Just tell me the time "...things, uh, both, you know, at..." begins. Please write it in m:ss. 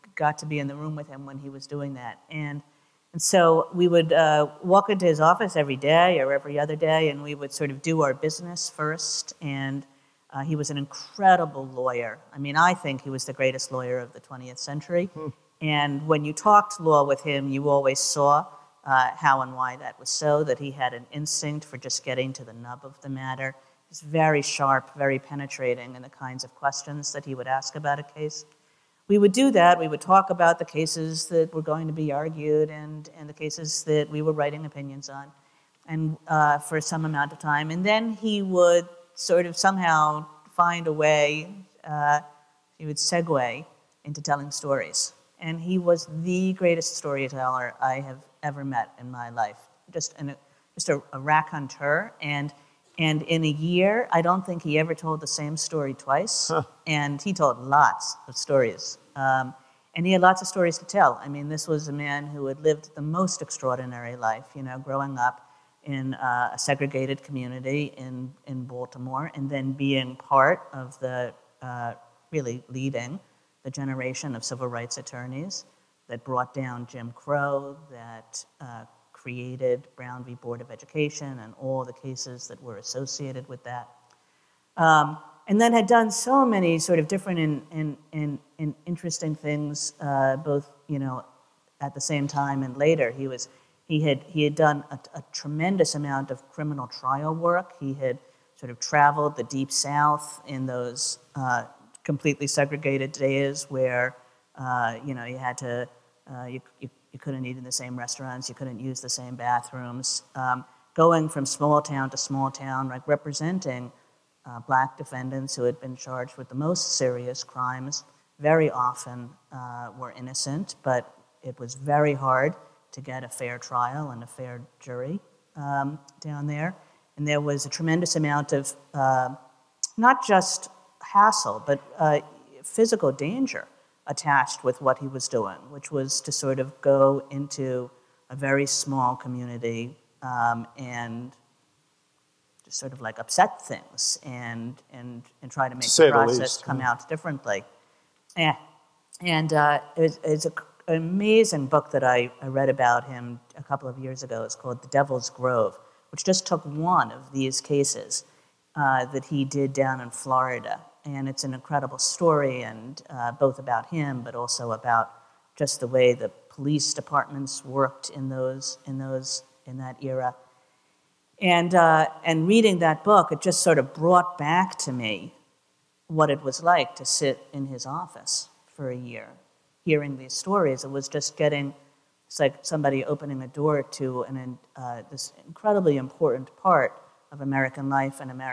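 1:29.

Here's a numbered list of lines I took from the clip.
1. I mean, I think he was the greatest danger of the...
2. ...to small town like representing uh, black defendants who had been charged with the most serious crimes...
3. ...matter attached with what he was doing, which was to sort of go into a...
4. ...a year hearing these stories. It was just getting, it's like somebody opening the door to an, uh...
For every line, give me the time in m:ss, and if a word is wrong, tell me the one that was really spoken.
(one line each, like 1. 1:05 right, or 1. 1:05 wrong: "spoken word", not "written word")
1. 0:12 wrong: "lawyer", not "danger"
2. 1:52 right
3. 2:13 wrong: "danger", not "matter"
4. 2:58 right.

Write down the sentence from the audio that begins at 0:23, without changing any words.
He's very sharp, very penetrating in the kinds of questions that he would ask about a case.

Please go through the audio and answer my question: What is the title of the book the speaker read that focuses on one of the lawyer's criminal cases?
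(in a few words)
The Devil's Grove.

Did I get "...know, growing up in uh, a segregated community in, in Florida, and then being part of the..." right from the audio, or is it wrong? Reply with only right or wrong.
wrong.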